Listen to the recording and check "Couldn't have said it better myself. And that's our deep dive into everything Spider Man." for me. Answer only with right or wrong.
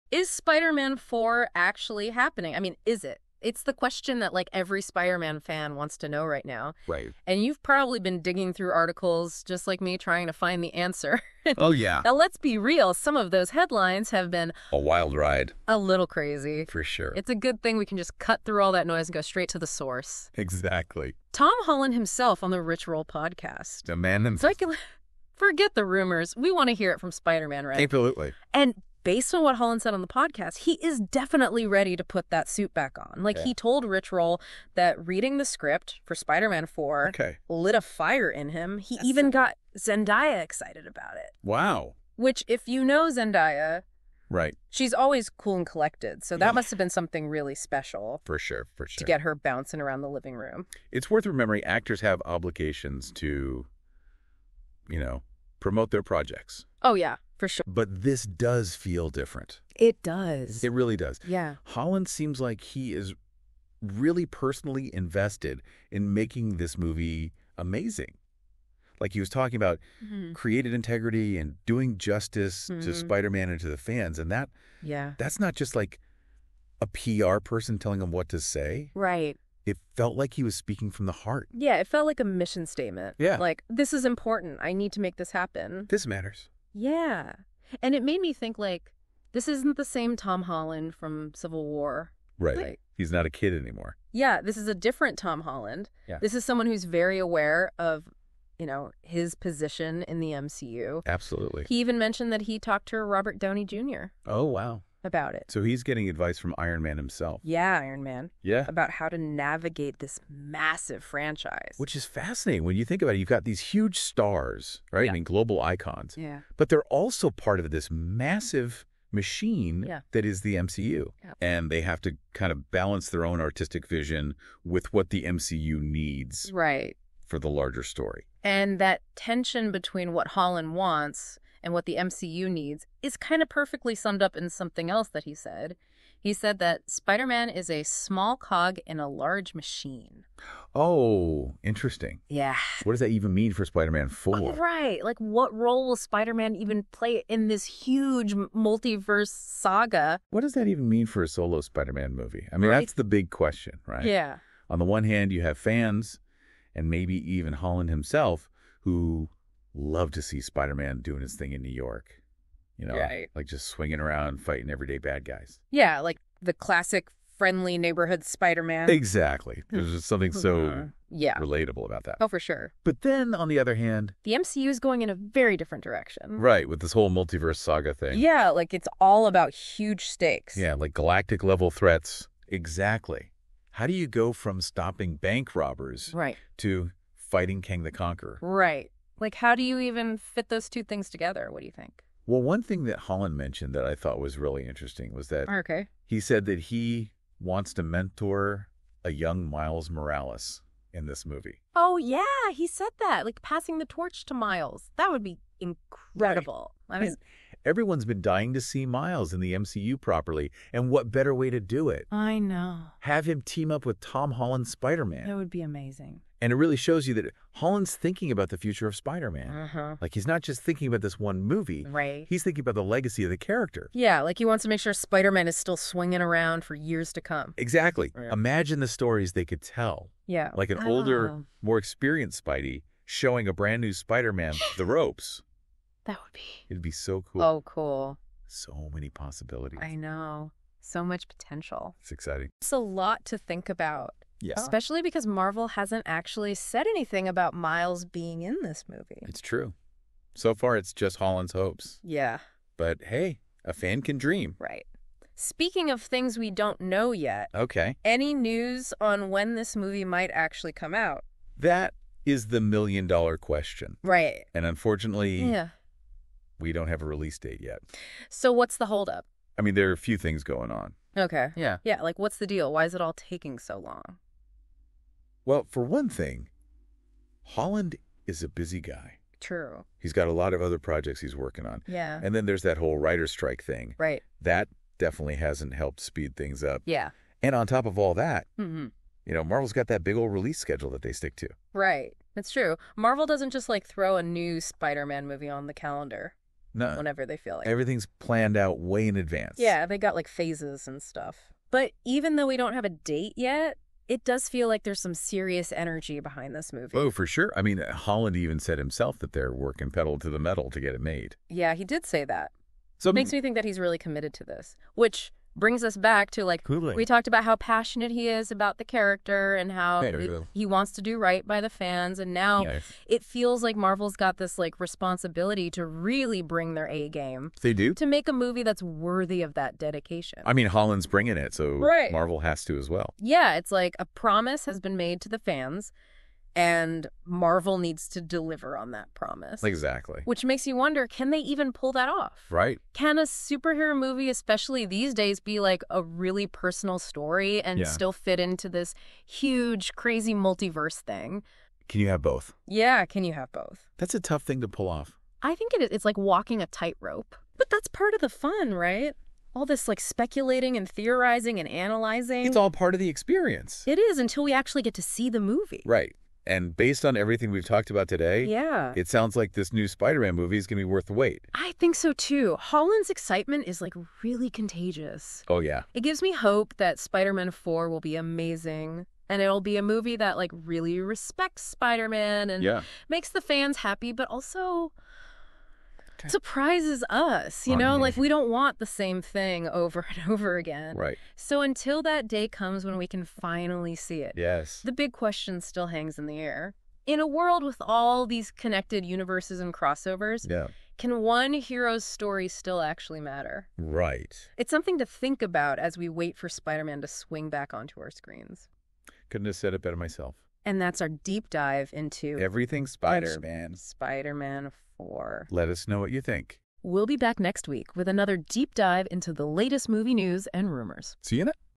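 right.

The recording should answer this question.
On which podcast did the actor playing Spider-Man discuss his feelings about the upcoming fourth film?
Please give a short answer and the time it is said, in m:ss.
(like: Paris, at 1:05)
Rich Roll podcast, at 0:22.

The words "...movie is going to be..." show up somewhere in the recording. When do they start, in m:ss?
6:10.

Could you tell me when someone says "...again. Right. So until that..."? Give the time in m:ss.
6:30.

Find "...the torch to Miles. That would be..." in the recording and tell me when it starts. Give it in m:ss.
3:23.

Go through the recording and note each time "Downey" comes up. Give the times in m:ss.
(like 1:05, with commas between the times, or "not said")
1:43.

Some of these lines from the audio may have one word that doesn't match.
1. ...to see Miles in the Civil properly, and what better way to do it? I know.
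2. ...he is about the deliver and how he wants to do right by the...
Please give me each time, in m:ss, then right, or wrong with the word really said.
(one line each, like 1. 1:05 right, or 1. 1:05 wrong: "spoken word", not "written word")
1. 3:28 wrong: "MCU", not "Civil"
2. 5:18 wrong: "character", not "deliver".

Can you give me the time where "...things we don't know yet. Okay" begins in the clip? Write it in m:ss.
4:16.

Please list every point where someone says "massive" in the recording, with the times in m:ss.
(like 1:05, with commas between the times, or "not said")
1:50, 1:57.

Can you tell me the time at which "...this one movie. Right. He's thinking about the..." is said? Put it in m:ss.
3:41.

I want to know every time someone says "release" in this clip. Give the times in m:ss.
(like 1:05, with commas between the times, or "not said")
4:27, 4:50.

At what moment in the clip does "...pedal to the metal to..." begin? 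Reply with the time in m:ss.
5:09.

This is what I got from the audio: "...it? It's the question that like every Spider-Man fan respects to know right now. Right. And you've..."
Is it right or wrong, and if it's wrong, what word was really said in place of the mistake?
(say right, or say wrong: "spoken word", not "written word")
wrong: "wants", not "respects".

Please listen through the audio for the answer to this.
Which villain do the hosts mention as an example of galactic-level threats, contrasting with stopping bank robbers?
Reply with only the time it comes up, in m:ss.
3:07.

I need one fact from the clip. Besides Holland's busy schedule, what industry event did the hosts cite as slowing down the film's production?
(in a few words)
Writer strike.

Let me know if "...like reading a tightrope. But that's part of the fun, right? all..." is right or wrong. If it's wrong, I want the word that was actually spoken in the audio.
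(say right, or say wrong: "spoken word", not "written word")
wrong: "walking", not "reading".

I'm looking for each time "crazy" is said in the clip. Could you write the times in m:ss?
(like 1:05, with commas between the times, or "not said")
0:16, 5:49.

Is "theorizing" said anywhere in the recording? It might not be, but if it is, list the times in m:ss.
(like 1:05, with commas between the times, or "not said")
6:00.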